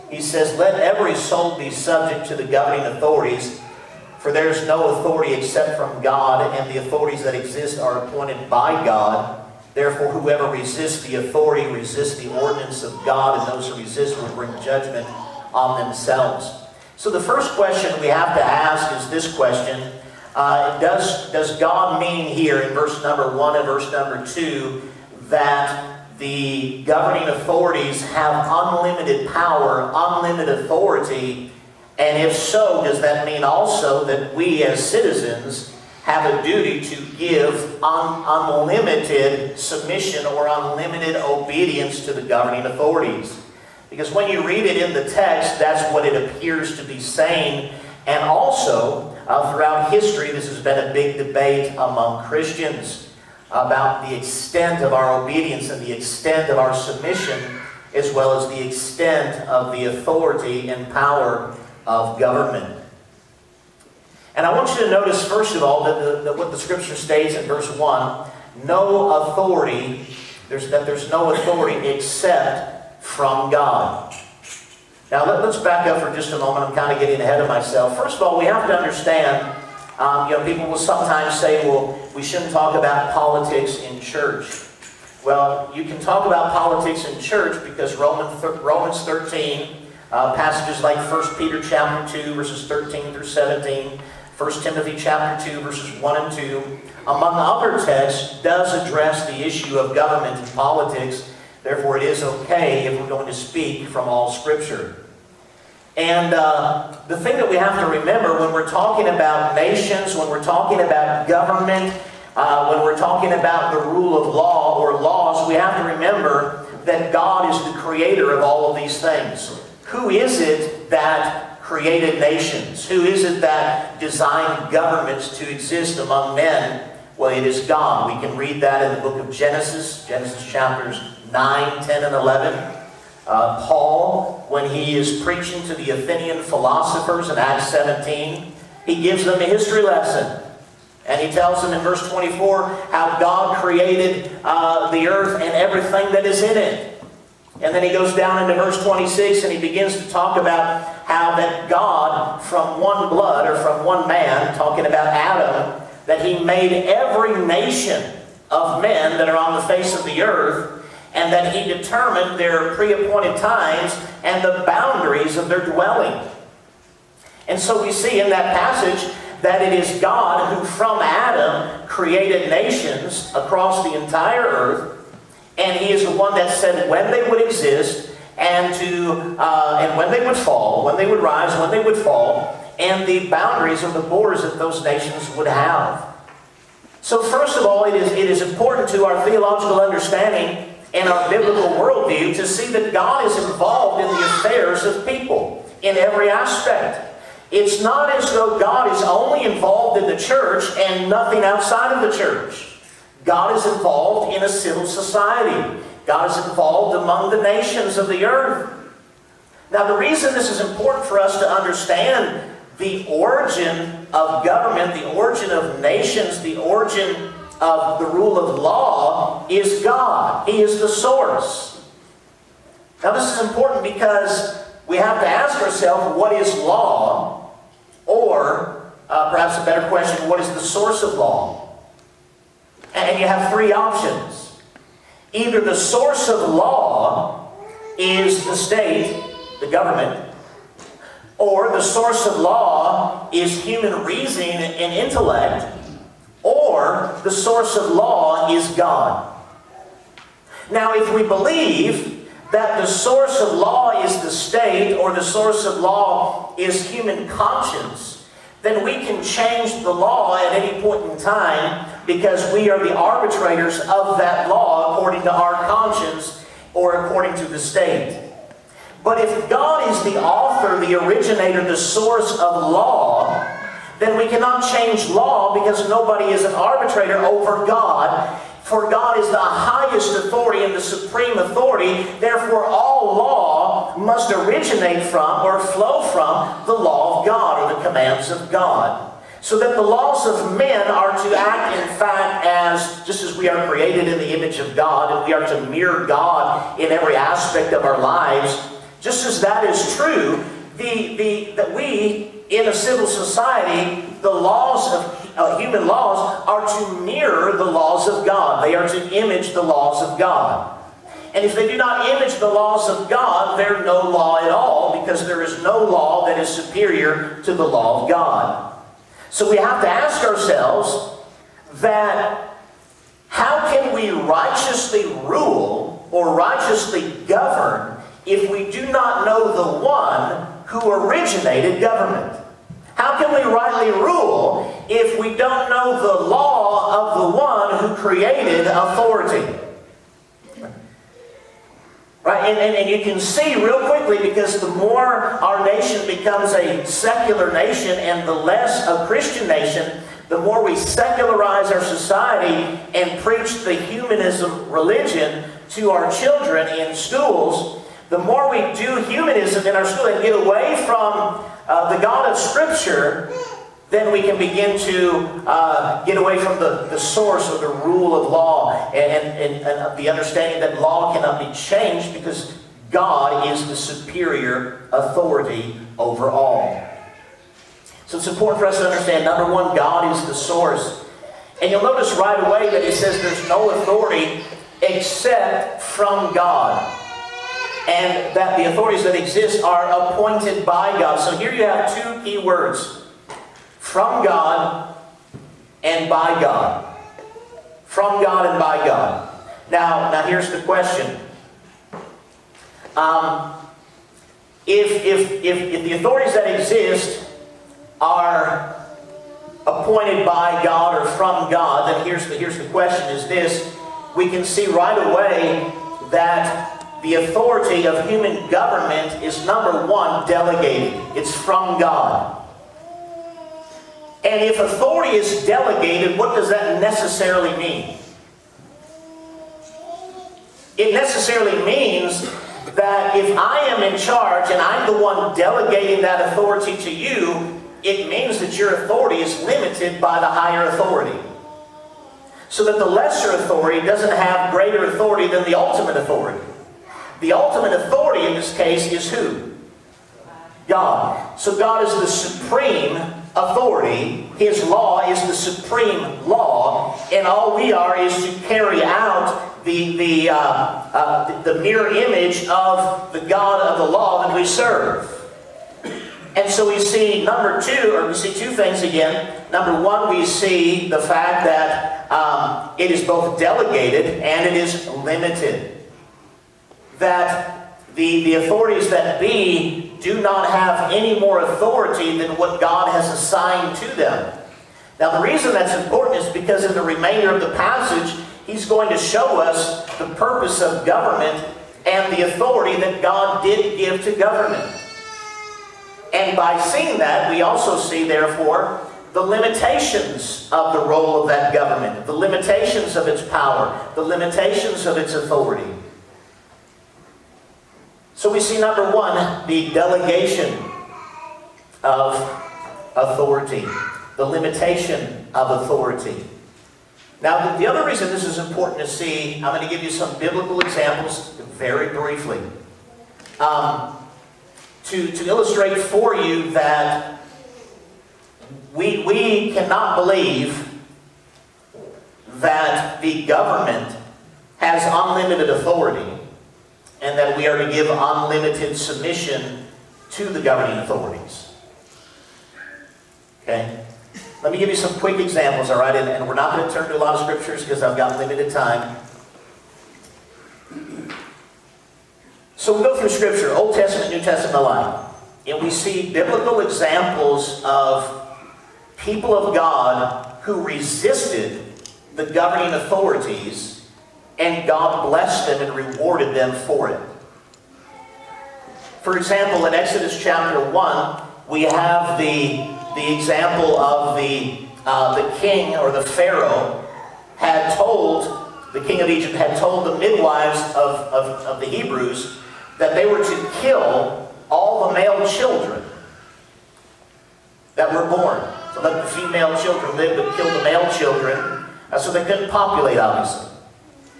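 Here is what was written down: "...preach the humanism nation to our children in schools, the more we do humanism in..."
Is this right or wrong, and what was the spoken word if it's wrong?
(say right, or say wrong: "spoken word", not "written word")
wrong: "religion", not "nation".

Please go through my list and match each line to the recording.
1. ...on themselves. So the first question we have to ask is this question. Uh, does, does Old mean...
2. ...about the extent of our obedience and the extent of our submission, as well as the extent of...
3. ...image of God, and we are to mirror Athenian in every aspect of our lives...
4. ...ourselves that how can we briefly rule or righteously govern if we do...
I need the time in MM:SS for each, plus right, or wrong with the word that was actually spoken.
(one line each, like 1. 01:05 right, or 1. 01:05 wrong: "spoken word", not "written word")
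1. 00:15 wrong: "God", not "Old"
2. 00:53 right
3. 04:54 wrong: "God", not "Athenian"
4. 05:20 wrong: "righteously", not "briefly".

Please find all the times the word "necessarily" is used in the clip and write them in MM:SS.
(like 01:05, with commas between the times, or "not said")
07:06, 07:10.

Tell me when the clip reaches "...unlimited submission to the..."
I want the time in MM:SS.
08:57.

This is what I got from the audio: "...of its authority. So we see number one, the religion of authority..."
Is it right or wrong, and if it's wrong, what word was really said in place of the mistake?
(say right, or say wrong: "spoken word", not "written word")
wrong: "delegation", not "religion".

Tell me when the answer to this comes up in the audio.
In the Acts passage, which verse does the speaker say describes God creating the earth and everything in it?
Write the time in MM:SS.
02:21.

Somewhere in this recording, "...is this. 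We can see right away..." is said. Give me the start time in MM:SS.
06:53.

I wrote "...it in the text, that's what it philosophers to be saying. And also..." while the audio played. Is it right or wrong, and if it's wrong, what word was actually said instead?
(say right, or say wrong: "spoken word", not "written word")
wrong: "appears", not "philosophers".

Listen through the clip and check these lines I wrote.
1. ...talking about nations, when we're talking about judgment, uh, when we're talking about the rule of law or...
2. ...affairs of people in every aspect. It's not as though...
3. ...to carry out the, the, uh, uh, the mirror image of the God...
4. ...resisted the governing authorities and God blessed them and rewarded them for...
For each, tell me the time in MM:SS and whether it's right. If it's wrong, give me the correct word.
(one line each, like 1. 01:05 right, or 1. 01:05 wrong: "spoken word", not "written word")
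1. 01:48 wrong: "government", not "judgment"
2. 03:14 right
3. 07:38 right
4. 09:20 right.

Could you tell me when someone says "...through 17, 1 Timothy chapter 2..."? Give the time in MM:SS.
01:33.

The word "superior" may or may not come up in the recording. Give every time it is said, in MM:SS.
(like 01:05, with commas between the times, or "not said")
05:16, 06:13.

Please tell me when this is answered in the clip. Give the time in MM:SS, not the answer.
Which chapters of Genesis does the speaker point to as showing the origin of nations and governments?
02:10.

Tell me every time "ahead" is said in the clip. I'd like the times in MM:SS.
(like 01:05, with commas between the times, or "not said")
01:17.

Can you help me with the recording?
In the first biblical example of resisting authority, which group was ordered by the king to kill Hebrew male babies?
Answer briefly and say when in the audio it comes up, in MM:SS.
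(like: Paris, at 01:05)
The midwives, at 09:39.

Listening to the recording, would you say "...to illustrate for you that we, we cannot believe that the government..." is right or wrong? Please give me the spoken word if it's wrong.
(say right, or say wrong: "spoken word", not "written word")
right.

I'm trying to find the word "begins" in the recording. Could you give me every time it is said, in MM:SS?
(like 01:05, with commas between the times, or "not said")
02:29, 06:04.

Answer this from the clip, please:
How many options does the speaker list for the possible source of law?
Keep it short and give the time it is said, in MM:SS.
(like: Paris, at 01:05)
3, at 03:53.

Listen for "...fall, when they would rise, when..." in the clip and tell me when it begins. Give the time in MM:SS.
03:00.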